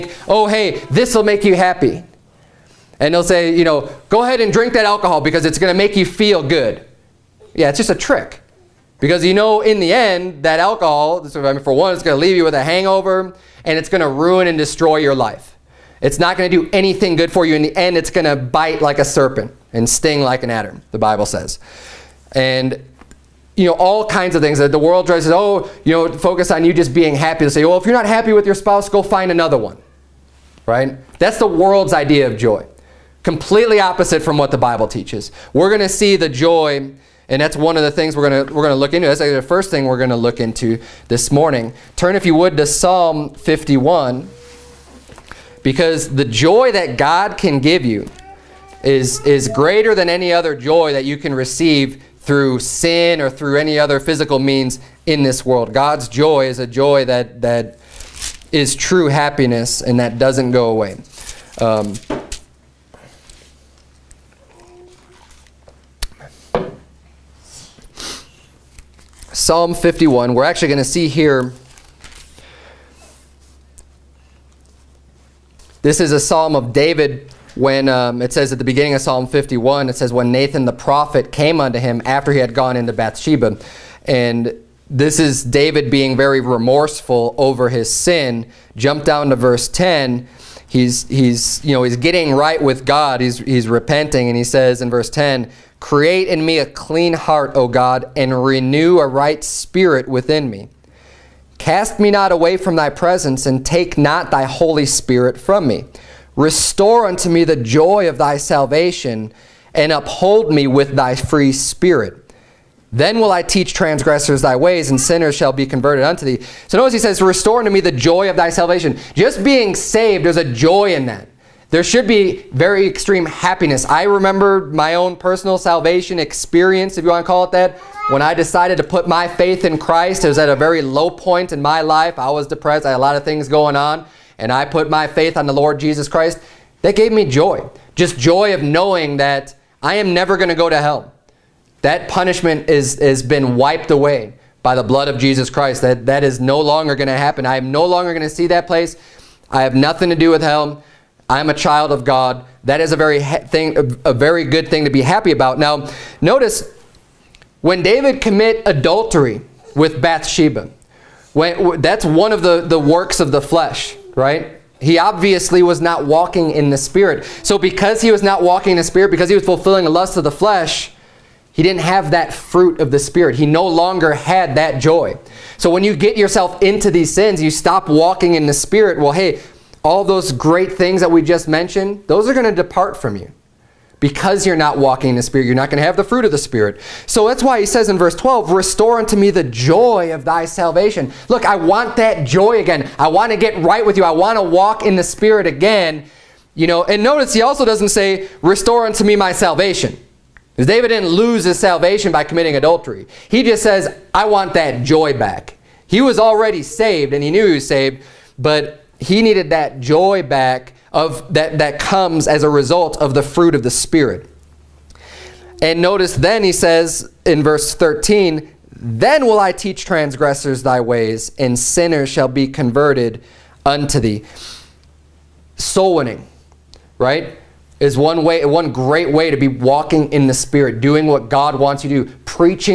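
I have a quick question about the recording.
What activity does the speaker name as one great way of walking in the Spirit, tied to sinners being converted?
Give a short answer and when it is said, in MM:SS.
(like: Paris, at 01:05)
Soul winning, at 03:45.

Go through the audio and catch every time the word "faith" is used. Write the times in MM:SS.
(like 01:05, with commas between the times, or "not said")
02:09, 02:15.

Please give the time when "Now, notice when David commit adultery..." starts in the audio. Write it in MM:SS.
02:35.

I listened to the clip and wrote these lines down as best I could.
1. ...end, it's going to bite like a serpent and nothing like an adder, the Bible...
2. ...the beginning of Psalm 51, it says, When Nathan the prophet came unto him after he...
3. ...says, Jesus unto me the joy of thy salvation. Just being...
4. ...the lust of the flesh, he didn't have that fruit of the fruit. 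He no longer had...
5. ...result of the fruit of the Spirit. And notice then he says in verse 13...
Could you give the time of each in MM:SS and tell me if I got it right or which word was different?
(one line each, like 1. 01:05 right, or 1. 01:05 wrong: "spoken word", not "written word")
1. 00:17 wrong: "sting", not "nothing"
2. 01:18 right
3. 01:56 wrong: "Restore", not "Jesus"
4. 02:49 wrong: "spirit", not "fruit"
5. 03:32 right.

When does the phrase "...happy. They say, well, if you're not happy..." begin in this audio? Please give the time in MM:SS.
00:27.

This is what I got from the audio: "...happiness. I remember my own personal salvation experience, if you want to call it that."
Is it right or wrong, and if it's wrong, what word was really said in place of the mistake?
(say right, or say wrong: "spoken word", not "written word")
right.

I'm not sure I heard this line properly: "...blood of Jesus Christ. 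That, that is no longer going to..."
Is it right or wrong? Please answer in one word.
right.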